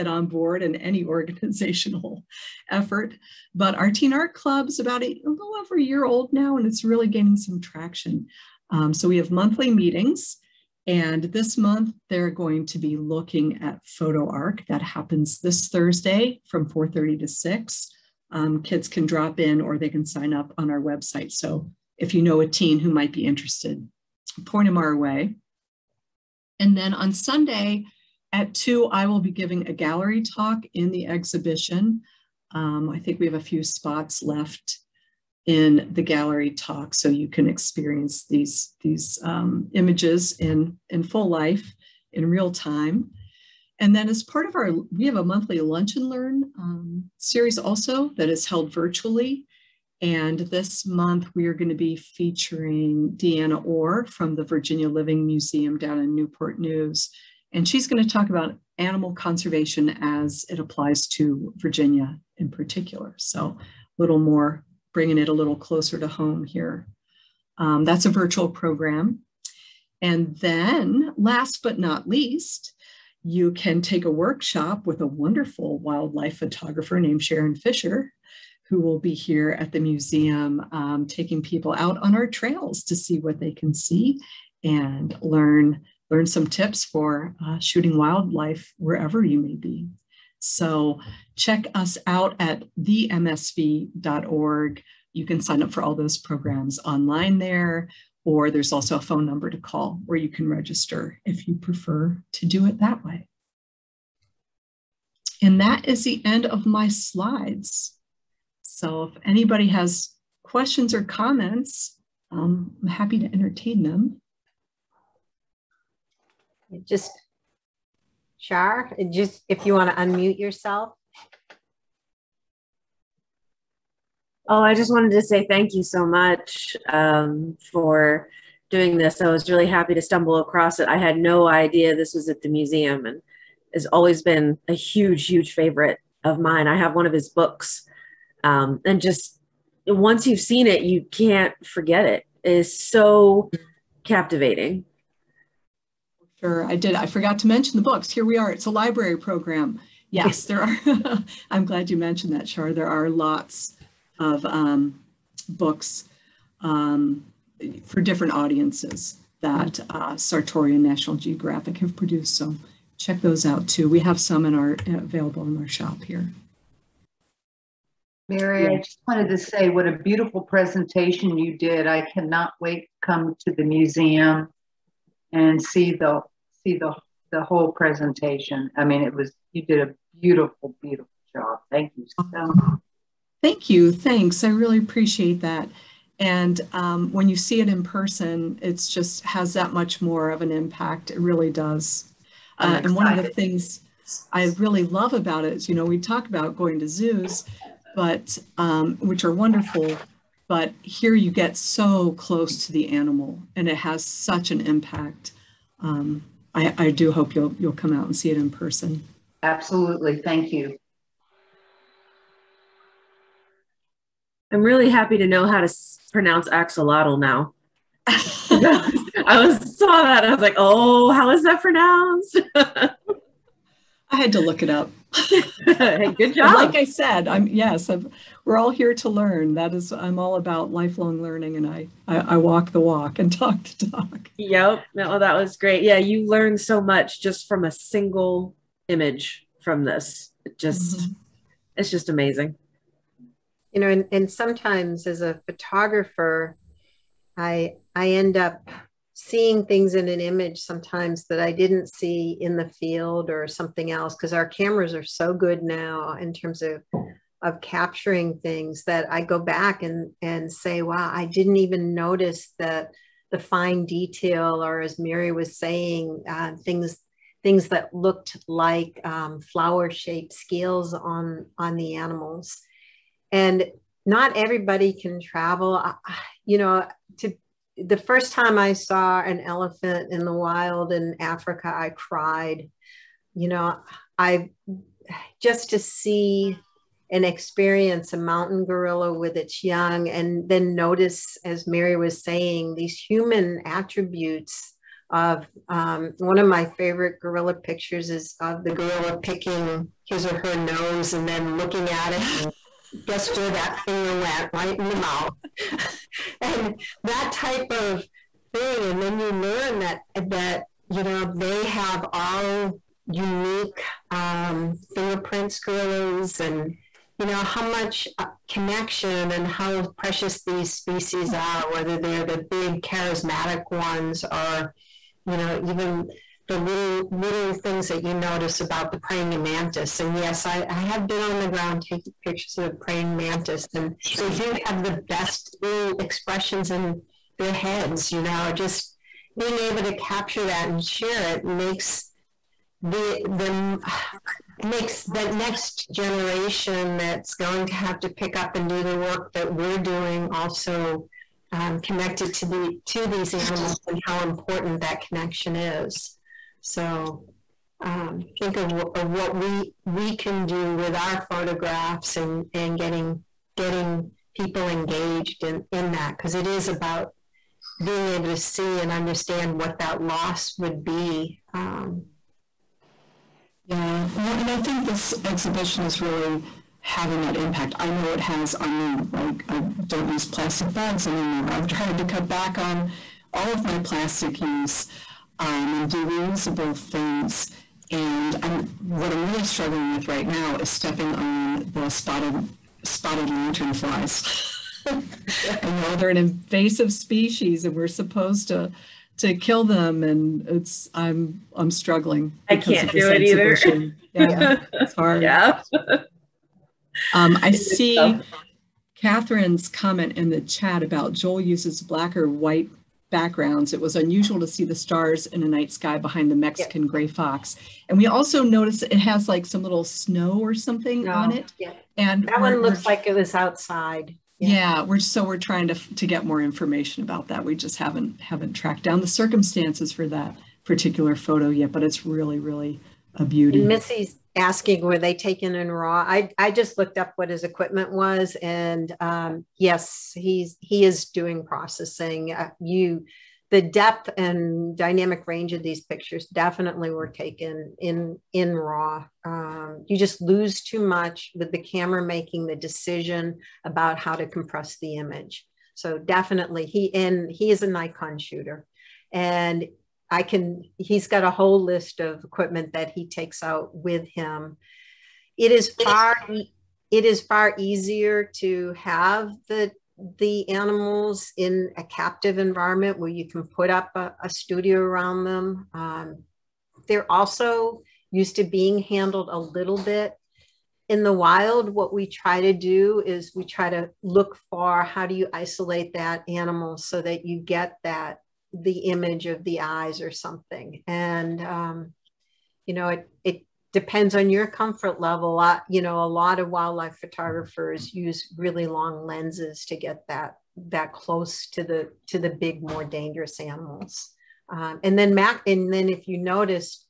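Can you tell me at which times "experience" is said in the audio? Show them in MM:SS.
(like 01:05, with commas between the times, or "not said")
00:37, 04:47.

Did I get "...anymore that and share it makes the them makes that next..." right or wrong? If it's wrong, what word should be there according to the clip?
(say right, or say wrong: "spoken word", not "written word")
wrong: "capture", not "anymore".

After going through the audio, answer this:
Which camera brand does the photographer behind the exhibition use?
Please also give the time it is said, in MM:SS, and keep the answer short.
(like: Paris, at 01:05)
Nikon, at 07:37.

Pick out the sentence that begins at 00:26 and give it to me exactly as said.
And then on Sunday at 2, I will be giving a gallery talk in the exhibition.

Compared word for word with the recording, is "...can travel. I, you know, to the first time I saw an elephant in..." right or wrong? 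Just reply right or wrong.
right.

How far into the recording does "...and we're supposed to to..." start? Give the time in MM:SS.
06:37.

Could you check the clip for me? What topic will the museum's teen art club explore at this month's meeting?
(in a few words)
PhotoArk.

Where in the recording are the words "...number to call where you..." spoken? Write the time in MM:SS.
01:39.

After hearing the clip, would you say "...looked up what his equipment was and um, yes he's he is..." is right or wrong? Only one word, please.
right.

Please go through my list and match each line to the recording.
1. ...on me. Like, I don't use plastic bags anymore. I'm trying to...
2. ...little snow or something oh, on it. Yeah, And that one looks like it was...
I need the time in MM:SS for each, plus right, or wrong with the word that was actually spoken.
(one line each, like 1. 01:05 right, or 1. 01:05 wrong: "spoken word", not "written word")
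1. 06:18 right
2. 06:59 right.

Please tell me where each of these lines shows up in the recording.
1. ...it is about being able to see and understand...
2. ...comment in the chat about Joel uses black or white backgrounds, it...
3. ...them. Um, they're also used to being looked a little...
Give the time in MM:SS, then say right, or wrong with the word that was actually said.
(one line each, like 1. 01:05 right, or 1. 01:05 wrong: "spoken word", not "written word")
1. 06:06 right
2. 06:49 right
3. 07:55 wrong: "handled", not "looked".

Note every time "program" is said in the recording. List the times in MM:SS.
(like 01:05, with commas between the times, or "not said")
01:08, 01:36, 02:29.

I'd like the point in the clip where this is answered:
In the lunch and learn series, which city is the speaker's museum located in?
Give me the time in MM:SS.
00:56.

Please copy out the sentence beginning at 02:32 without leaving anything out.
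There are lots of um, books um, for different audiences that uh, Sartore and National Geographic have produced.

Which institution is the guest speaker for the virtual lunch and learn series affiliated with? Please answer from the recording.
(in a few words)
Virginia Living Museum.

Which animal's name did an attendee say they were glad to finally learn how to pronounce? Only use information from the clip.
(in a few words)
axolotl.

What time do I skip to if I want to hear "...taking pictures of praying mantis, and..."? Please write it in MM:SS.
05:31.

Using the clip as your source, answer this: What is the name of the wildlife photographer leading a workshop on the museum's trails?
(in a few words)
Sharon Fisher.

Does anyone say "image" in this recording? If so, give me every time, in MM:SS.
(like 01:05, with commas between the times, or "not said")
00:39, 03:58, 04:10, 07:34, 08:08.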